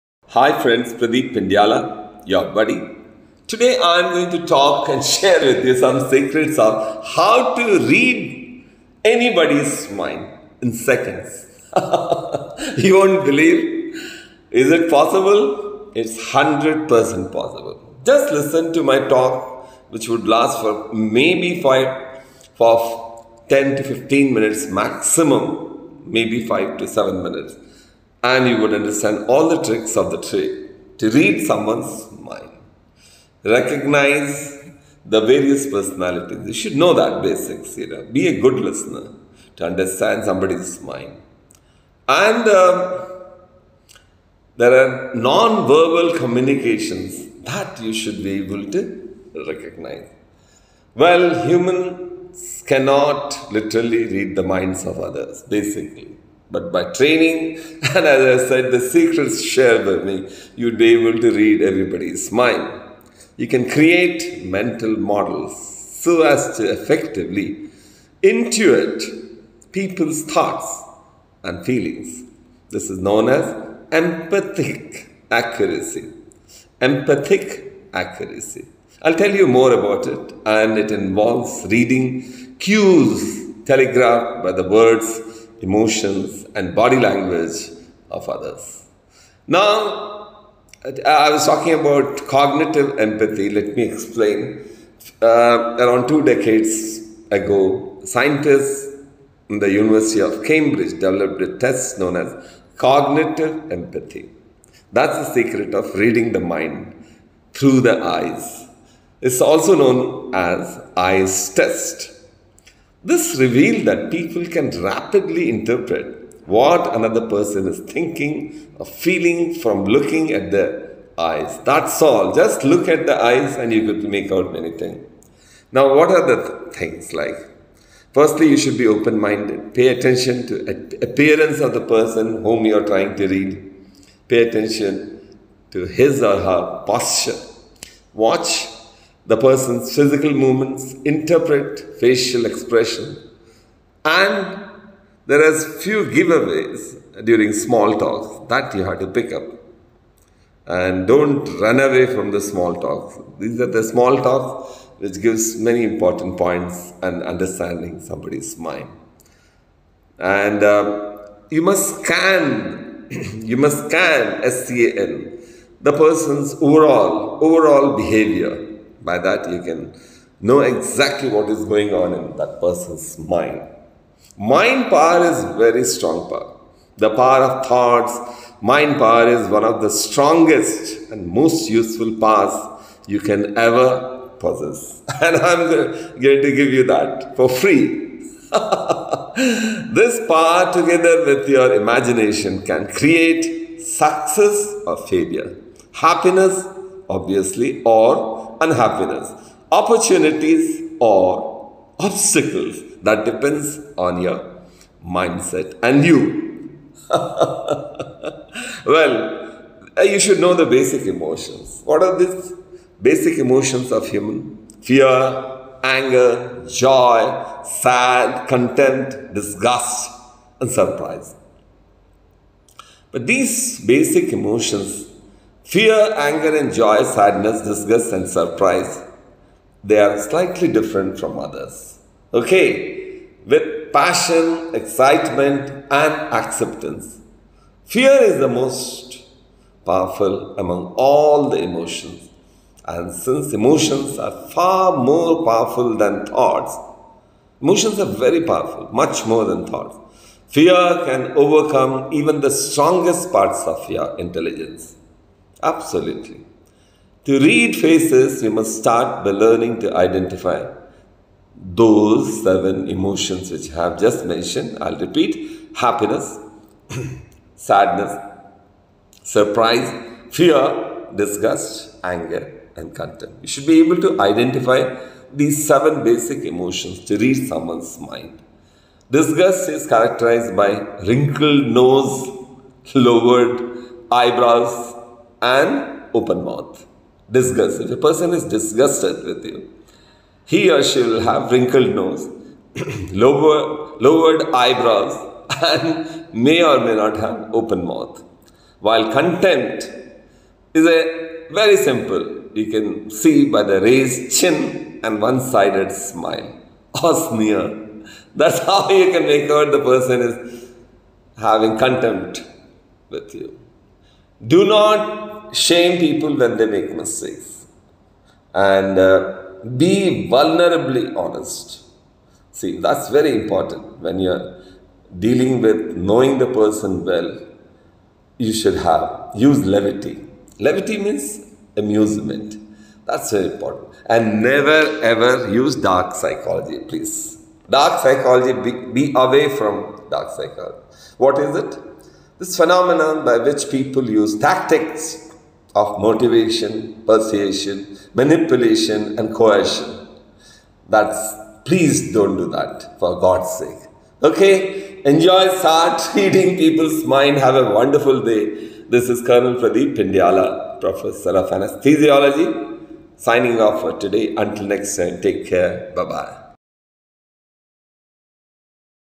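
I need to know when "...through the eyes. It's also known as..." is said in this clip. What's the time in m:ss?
1:47.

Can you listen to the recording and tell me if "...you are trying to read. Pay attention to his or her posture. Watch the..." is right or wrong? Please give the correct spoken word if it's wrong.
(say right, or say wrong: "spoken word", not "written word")
right.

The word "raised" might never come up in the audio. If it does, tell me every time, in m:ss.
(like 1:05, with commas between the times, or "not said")
5:03.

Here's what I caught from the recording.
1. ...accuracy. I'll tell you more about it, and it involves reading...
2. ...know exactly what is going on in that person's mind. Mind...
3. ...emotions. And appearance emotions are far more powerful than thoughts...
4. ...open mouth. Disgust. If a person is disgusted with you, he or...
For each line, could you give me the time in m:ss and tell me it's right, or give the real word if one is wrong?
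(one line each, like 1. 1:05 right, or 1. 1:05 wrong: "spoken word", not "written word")
1. 1:17 right
2. 2:50 right
3. 4:01 wrong: "since", not "appearance"
4. 4:46 right.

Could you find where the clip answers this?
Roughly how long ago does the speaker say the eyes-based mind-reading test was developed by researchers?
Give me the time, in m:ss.
1:36.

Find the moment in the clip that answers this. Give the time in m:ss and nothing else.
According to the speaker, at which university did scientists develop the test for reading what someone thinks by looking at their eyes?
1:39.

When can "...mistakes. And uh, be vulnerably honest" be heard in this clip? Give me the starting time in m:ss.
5:16.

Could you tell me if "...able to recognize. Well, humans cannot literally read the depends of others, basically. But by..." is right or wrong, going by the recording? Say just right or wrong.
wrong.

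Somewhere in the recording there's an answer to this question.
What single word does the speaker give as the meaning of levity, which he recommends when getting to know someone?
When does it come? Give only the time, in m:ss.
5:31.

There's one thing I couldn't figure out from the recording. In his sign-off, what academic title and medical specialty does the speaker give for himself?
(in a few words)
Professor of Anesthesiology.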